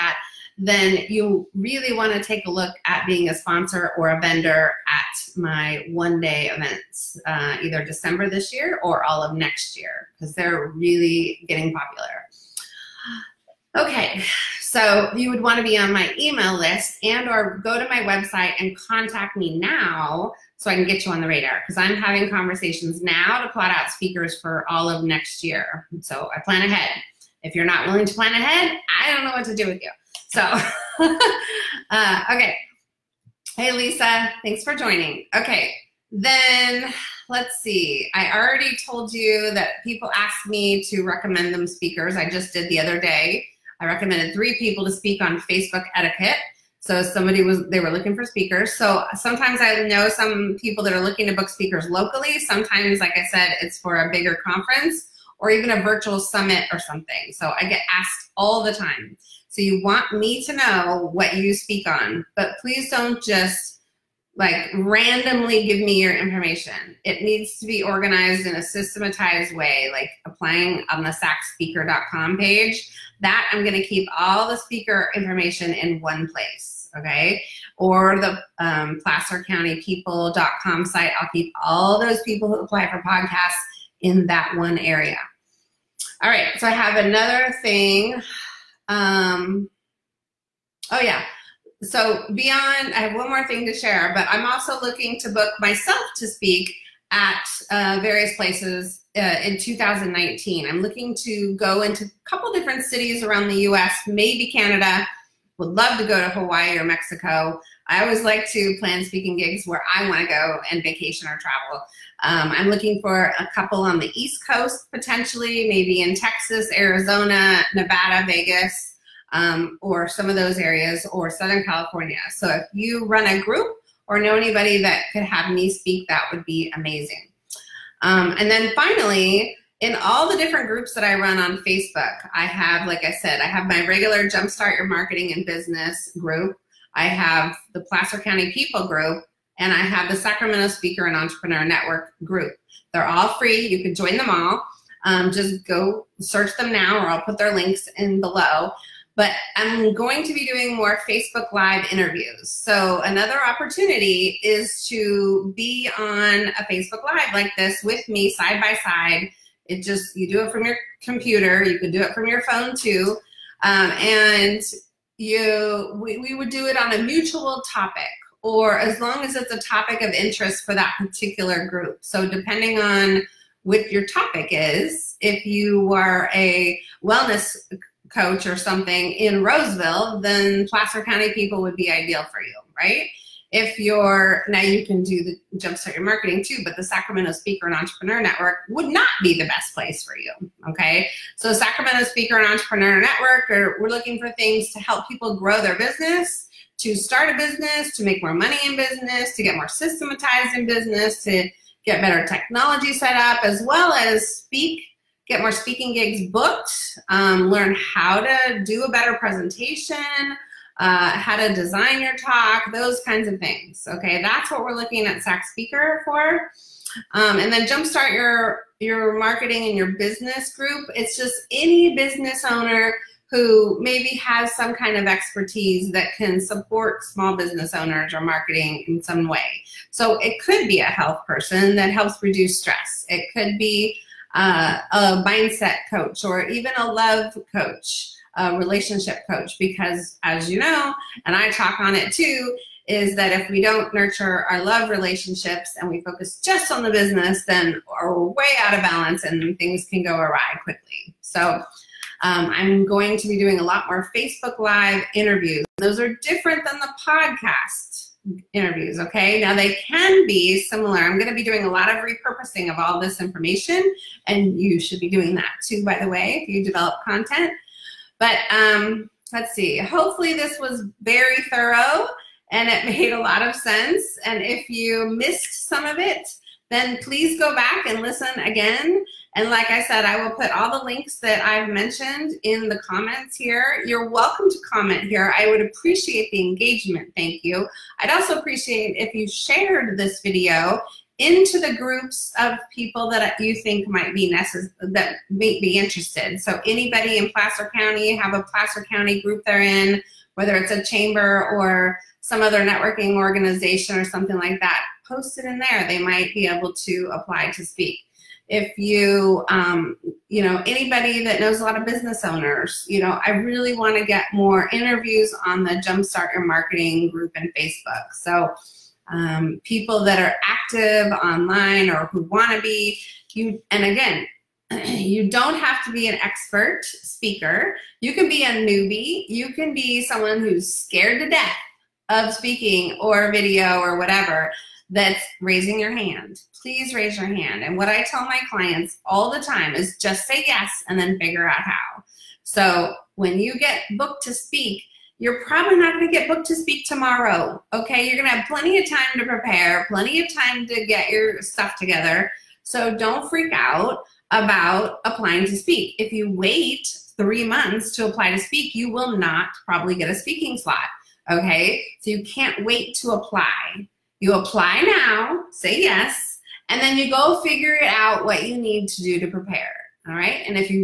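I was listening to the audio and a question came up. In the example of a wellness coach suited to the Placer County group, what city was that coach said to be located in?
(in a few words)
Roseville.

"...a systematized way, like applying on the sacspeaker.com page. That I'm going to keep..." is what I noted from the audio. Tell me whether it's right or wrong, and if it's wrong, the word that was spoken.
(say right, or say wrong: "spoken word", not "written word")
right.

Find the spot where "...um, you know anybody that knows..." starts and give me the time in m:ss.
5:09.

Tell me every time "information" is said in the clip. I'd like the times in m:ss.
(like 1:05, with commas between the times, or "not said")
1:06, 1:15, 4:23.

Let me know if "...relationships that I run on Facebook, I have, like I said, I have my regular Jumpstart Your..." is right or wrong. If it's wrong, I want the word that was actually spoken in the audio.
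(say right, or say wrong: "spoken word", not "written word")
wrong: "groups", not "relationships".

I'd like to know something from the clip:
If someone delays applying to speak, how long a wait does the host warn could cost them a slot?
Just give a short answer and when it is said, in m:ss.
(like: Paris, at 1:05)
3 months, at 5:57.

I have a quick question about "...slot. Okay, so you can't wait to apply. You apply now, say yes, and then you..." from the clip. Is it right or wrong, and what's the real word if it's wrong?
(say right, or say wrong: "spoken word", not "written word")
right.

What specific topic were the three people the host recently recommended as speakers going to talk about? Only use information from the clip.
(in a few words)
Facebook etiquette.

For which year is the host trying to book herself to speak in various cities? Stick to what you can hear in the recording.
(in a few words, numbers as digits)
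2019.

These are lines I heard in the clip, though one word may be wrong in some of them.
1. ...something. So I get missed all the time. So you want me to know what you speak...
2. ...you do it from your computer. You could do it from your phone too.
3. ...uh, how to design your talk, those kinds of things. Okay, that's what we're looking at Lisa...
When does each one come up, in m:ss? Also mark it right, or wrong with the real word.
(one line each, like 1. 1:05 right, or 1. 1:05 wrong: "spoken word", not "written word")
1. 0:56 wrong: "asked", not "missed"
2. 2:40 right
3. 3:30 wrong: "SAC", not "Lisa".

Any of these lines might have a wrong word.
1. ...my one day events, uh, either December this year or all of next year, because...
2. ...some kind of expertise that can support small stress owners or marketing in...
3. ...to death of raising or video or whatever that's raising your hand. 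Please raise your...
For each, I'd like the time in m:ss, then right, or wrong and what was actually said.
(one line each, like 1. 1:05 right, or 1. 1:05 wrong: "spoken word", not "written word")
1. 0:05 right
2. 3:44 wrong: "business", not "stress"
3. 5:31 wrong: "speaking", not "raising".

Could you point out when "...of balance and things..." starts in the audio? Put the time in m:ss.
4:08.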